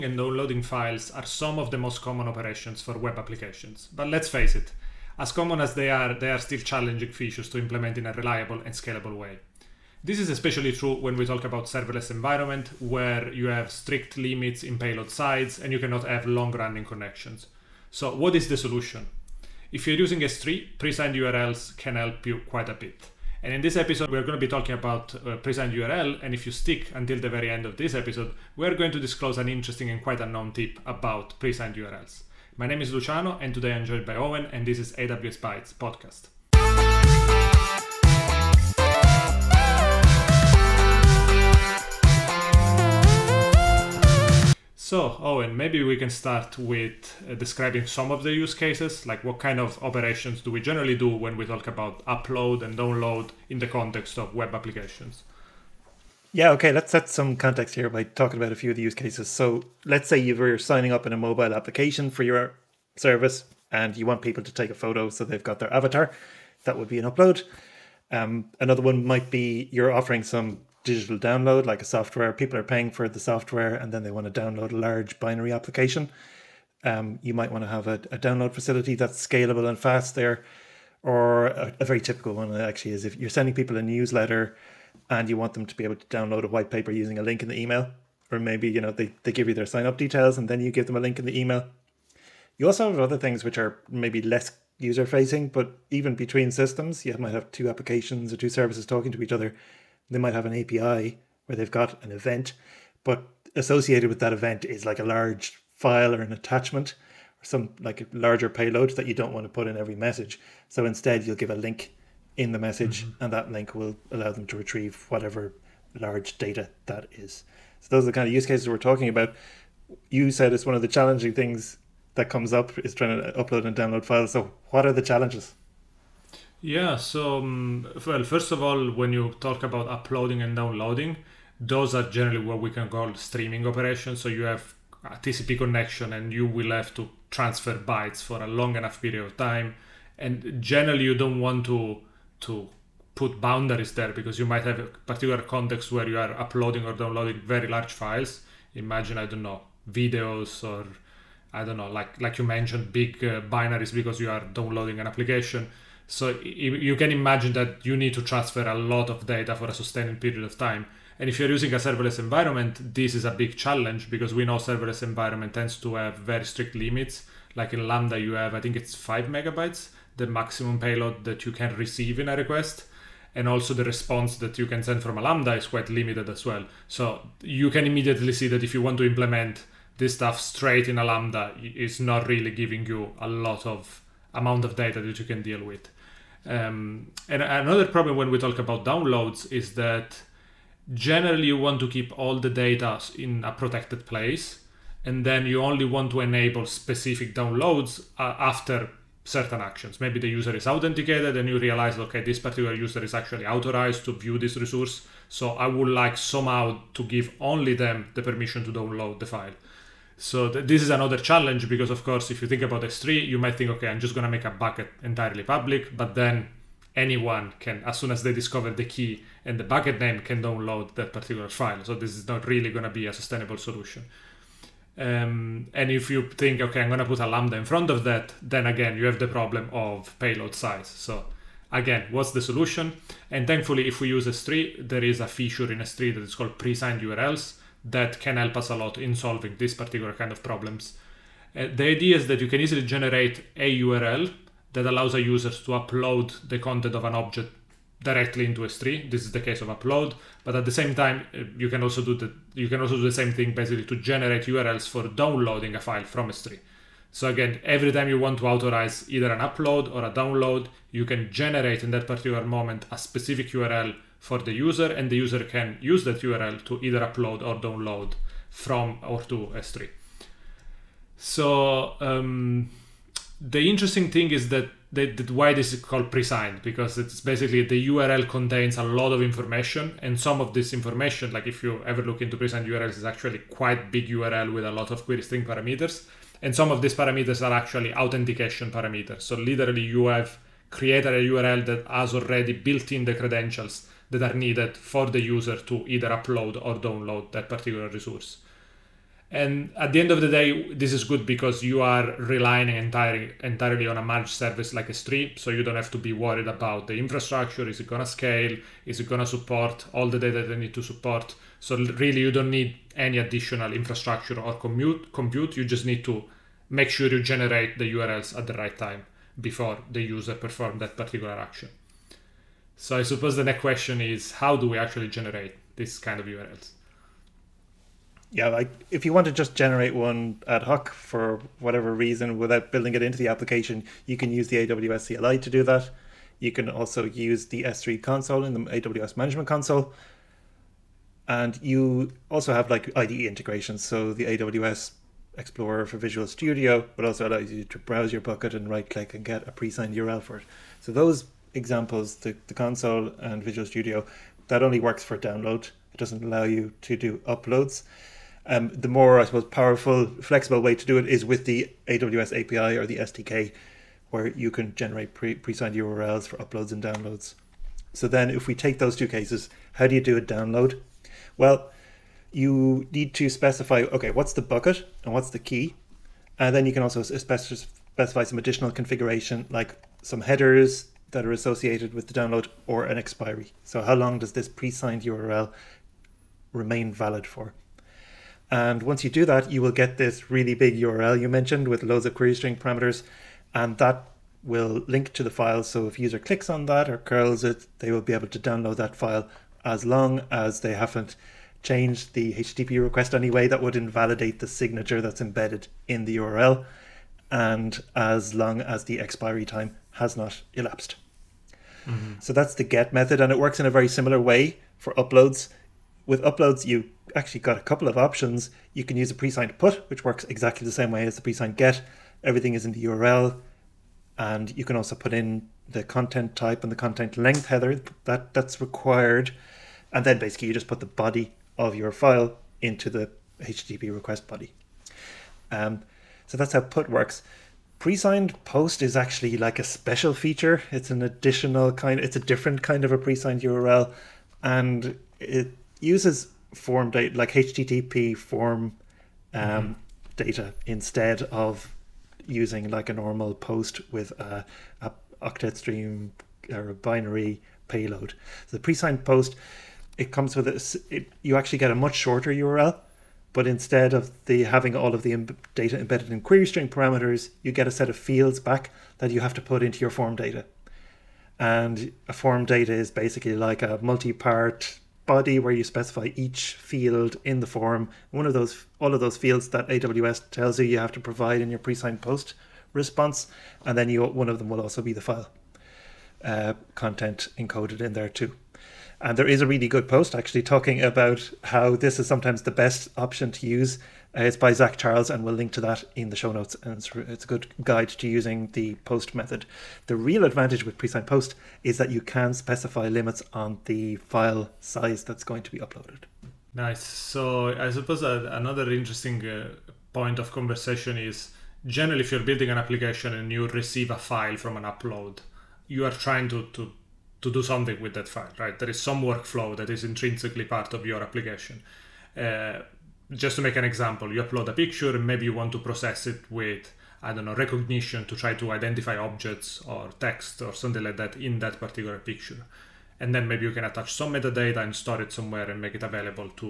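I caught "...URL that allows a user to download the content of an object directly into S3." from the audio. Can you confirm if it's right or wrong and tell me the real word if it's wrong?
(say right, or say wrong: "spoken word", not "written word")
wrong: "upload", not "download".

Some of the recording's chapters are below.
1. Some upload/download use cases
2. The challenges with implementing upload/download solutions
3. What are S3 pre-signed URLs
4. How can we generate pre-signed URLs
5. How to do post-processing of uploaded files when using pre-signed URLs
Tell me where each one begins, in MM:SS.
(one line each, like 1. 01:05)
1. 00:55
2. 02:05
3. 03:59
4. 05:26
5. 08:25.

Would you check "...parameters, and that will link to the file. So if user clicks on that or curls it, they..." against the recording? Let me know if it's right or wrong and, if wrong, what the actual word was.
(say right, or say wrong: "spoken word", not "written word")
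right.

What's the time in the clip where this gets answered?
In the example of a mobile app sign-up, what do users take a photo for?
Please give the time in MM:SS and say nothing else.
01:05.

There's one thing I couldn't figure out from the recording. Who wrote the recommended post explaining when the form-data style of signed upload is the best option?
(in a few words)
Zach Charles.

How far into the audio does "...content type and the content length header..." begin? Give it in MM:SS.
07:05.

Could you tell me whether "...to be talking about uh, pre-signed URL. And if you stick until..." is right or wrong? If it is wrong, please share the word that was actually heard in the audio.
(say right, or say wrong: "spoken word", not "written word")
right.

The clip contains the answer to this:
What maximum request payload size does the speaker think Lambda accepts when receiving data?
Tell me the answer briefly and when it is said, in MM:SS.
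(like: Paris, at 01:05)
5 megabytes, at 02:48.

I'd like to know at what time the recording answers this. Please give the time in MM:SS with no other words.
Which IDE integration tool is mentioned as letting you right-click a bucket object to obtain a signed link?
05:44.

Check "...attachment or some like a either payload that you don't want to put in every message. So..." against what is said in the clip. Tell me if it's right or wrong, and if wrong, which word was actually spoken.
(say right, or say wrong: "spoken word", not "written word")
wrong: "larger", not "either".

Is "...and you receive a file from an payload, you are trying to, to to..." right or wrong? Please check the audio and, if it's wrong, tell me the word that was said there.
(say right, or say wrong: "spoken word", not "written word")
wrong: "upload", not "payload".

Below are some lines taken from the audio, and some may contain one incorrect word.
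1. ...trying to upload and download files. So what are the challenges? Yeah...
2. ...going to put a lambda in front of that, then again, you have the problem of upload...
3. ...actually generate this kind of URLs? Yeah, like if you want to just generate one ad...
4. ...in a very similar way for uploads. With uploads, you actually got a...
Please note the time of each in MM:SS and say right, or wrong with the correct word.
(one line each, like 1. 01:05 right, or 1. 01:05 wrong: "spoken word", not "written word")
1. 02:02 right
2. 03:46 wrong: "payload", not "upload"
3. 05:24 right
4. 06:53 right.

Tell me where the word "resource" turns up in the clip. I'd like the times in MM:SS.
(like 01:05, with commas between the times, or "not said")
03:24, 04:57.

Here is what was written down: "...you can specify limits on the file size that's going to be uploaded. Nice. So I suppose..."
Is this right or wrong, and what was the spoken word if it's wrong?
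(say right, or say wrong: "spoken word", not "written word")
right.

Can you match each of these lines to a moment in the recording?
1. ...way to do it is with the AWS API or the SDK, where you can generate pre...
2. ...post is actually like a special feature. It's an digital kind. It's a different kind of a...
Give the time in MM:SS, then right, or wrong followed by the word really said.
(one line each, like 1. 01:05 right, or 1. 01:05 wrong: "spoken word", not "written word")
1. 06:00 right
2. 07:18 wrong: "additional", not "digital".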